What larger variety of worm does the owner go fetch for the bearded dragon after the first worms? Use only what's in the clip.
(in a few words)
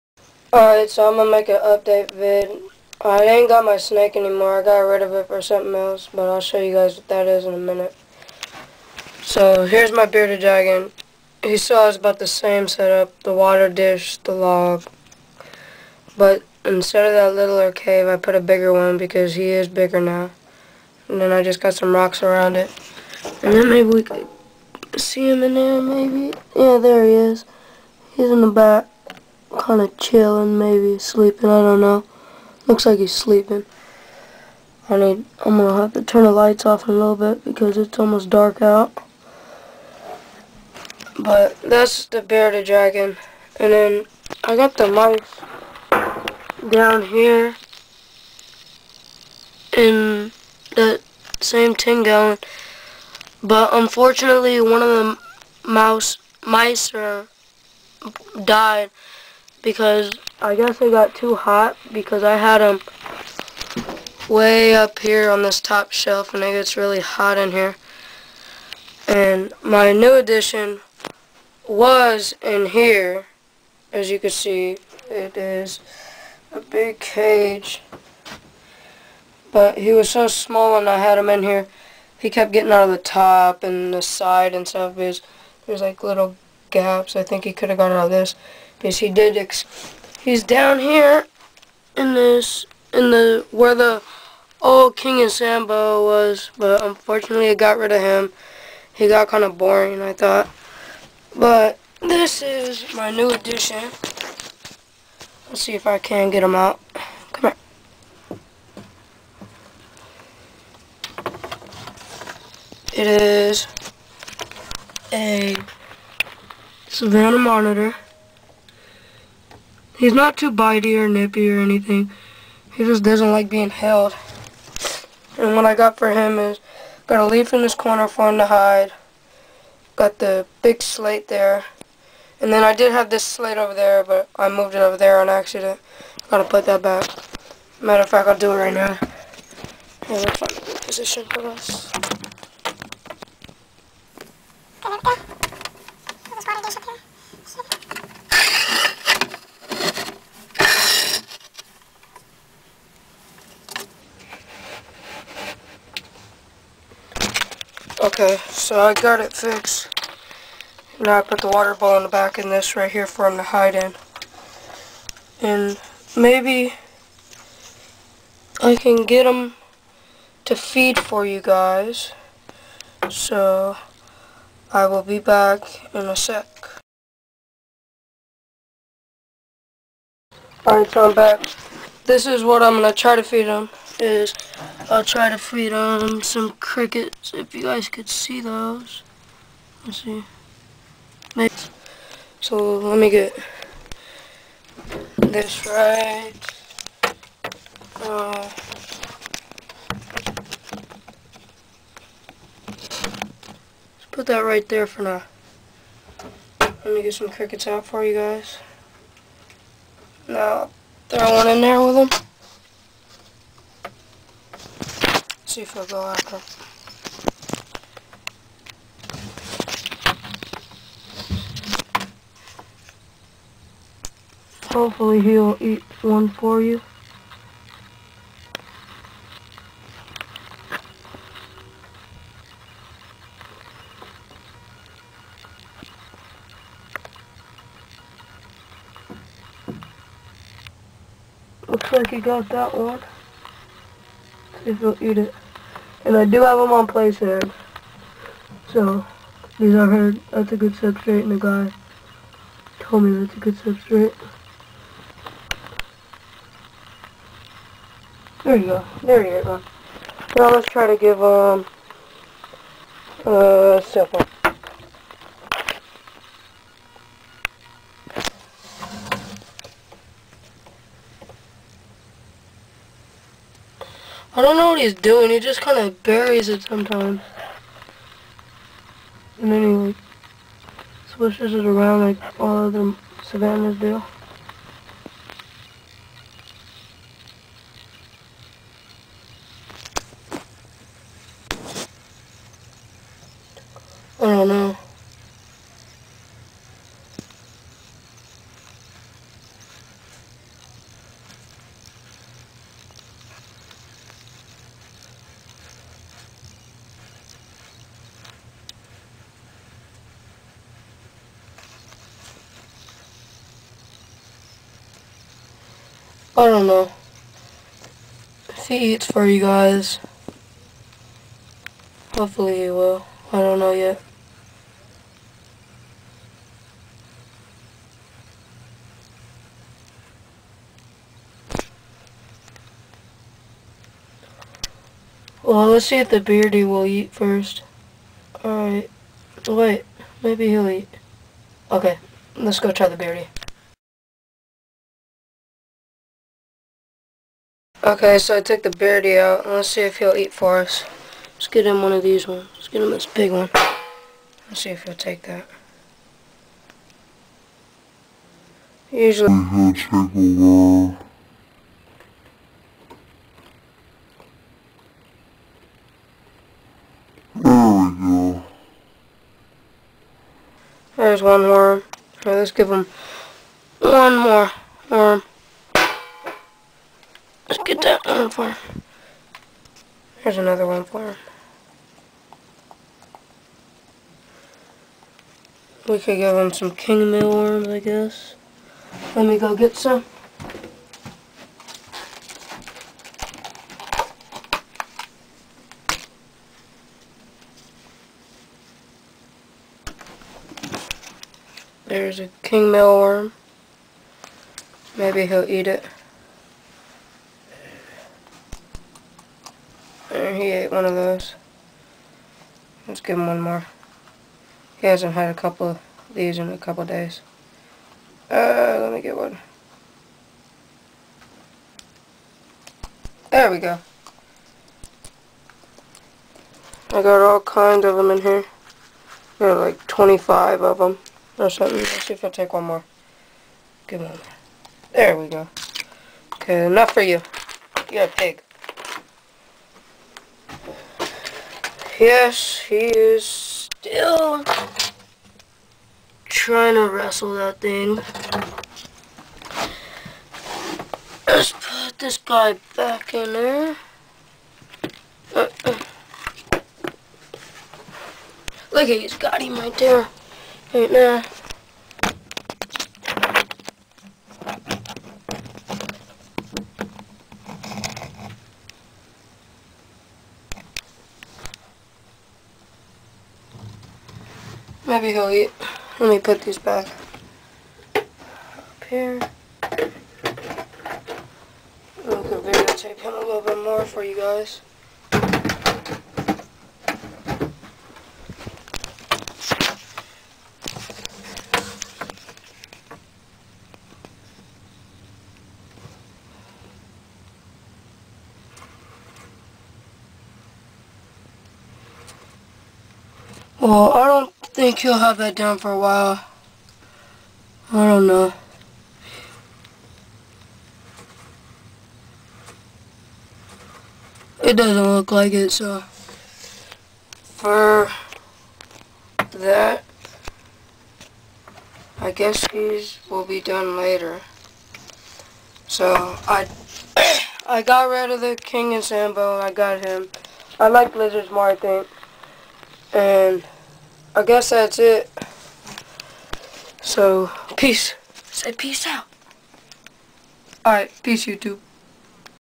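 King mealworms.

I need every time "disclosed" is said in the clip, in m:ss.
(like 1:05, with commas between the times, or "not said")
not said.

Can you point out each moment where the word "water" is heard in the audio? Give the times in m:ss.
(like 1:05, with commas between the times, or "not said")
0:13, 2:41.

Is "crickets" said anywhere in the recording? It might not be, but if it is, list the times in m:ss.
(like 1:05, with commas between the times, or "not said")
3:06, 3:27.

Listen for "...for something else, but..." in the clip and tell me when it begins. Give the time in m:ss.
0:05.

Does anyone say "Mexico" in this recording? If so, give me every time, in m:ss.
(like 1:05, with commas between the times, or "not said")
not said.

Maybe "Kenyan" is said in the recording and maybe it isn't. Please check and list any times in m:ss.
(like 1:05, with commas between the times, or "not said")
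1:34, 8:48.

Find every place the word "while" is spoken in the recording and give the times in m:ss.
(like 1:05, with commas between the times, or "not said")
5:59, 8:25.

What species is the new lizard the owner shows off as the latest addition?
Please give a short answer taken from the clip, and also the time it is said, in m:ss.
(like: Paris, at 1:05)
Savannah monitor, at 1:56.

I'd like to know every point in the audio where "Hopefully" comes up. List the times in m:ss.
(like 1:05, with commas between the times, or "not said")
3:44, 5:22.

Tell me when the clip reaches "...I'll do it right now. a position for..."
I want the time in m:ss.
2:18.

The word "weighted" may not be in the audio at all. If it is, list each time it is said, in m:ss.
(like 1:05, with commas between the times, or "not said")
not said.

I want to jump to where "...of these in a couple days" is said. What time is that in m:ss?
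6:55.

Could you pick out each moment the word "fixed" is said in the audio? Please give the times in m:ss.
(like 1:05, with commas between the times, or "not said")
2:39.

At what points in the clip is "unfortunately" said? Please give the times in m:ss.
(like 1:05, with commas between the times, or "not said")
0:53, 1:36.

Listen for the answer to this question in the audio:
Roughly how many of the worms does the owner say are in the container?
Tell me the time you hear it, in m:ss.
7:09.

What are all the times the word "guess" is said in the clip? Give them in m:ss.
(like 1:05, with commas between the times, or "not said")
1:00, 6:27, 8:42, 8:54.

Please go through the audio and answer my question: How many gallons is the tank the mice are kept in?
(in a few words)
10 gallon.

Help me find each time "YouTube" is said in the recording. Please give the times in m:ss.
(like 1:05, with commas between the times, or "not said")
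9:01.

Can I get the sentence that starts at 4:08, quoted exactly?
So, these are heard, that's a good substrate, and the guy told me that's a good substrate.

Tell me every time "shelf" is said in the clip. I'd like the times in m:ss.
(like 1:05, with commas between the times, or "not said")
1:05.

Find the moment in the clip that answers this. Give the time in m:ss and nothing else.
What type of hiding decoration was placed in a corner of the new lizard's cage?
2:07.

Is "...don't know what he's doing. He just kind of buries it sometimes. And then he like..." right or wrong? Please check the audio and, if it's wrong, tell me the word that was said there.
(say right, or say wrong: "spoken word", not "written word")
right.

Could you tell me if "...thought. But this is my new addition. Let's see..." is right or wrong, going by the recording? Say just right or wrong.
right.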